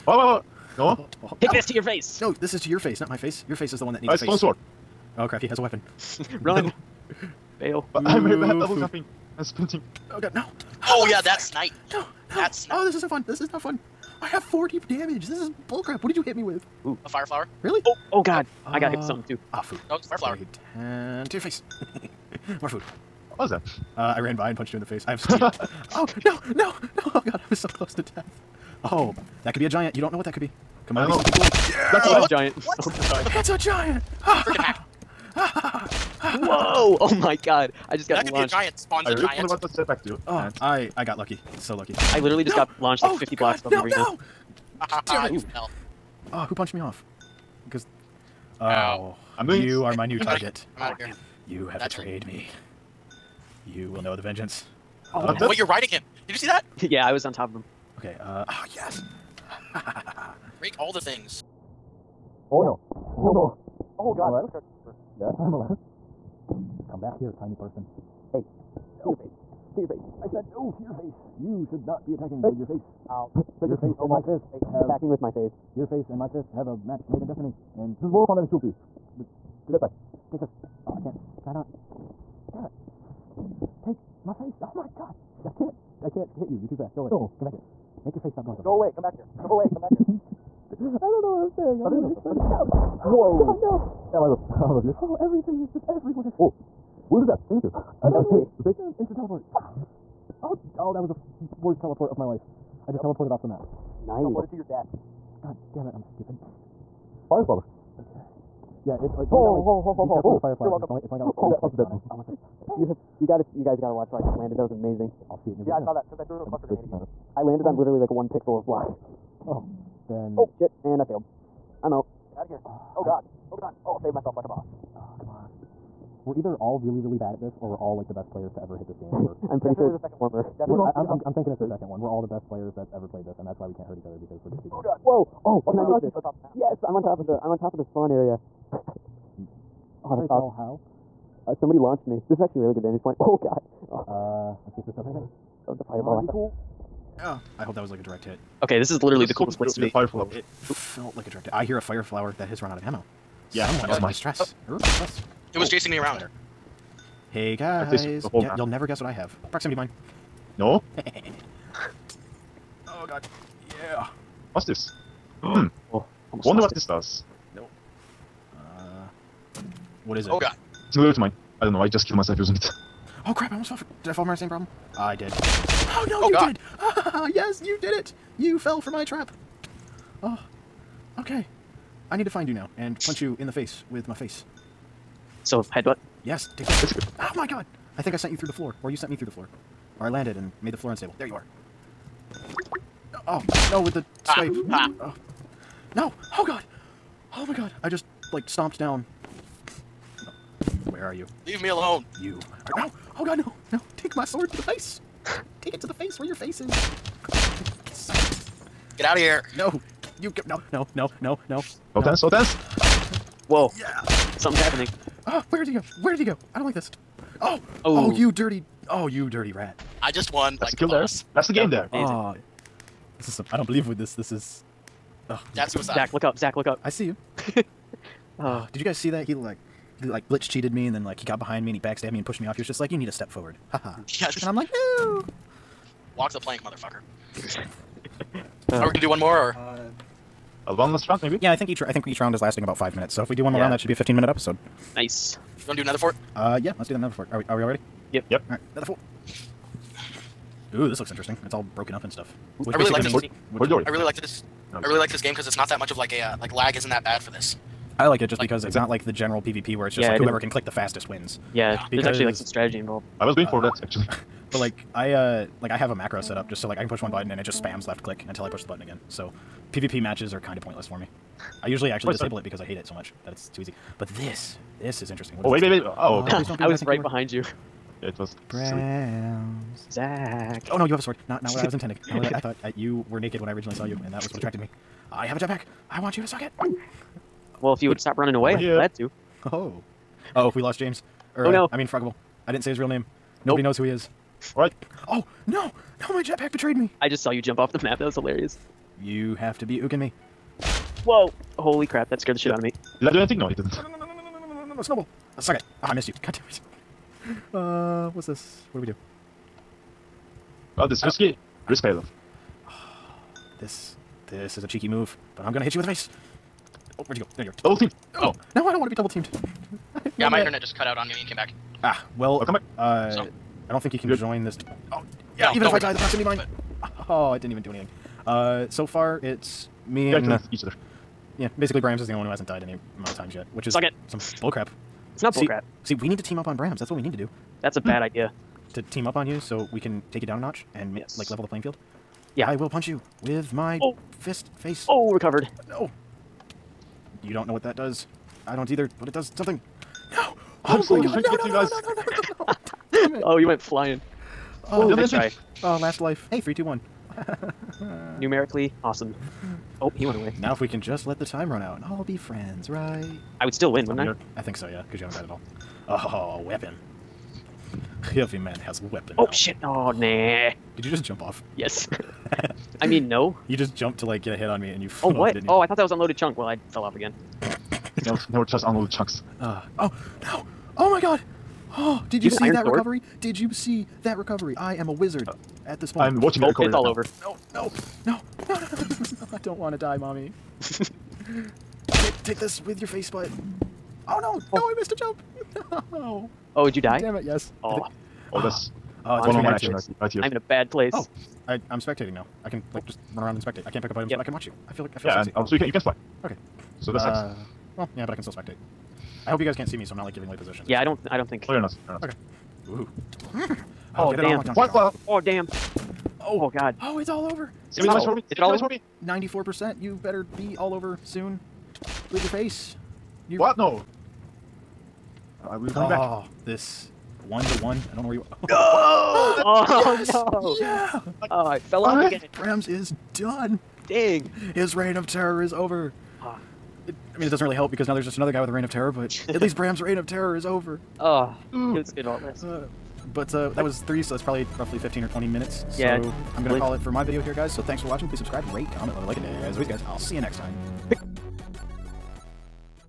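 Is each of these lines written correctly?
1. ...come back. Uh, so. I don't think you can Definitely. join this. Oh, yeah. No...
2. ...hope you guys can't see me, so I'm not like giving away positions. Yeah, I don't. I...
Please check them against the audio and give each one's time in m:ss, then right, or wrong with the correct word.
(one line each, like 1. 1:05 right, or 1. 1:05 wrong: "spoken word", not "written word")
1. 5:22 wrong: "Good", not "Definitely"
2. 6:49 right.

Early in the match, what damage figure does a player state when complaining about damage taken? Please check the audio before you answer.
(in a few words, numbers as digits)
40.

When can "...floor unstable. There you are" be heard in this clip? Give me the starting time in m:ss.
3:10.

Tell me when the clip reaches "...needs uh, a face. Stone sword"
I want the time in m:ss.
0:04.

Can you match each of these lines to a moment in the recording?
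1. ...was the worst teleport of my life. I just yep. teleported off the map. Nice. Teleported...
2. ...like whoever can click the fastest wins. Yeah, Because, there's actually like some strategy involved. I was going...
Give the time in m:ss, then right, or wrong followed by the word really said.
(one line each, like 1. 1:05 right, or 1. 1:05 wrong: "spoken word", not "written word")
1. 1:41 right
2. 4:20 right.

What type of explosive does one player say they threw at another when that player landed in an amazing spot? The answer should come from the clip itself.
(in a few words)
cluster grenade.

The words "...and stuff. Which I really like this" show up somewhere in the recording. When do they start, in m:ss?
4:12.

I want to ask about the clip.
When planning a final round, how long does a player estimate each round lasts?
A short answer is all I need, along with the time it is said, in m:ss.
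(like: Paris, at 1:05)
five minutes, at 4:02.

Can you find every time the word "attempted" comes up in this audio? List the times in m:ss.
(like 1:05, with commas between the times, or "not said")
not said.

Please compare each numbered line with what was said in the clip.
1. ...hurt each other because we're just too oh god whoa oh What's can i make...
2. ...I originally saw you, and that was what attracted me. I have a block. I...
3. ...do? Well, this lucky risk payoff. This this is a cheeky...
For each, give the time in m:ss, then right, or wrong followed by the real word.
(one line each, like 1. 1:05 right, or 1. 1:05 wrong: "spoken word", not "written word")
1. 2:13 right
2. 4:43 wrong: "jetpack", not "block"
3. 5:08 wrong: "risky", not "lucky".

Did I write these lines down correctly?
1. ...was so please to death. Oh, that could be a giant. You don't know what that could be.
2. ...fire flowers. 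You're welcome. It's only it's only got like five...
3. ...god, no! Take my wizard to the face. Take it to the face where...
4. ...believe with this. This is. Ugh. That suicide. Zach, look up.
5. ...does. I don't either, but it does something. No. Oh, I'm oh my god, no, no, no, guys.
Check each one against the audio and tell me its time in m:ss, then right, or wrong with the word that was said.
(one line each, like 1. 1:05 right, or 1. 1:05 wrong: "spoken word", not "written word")
1. 0:27 wrong: "close", not "please"
2. 1:50 wrong: "three", not "five"
3. 3:23 wrong: "sword", not "wizard"
4. 3:43 right
5. 5:47 right.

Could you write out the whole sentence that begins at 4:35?
What oh, is oh, wait, wait, wait, Oh.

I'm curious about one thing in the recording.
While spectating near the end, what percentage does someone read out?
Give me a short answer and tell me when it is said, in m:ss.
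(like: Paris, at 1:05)
94%, at 6:59.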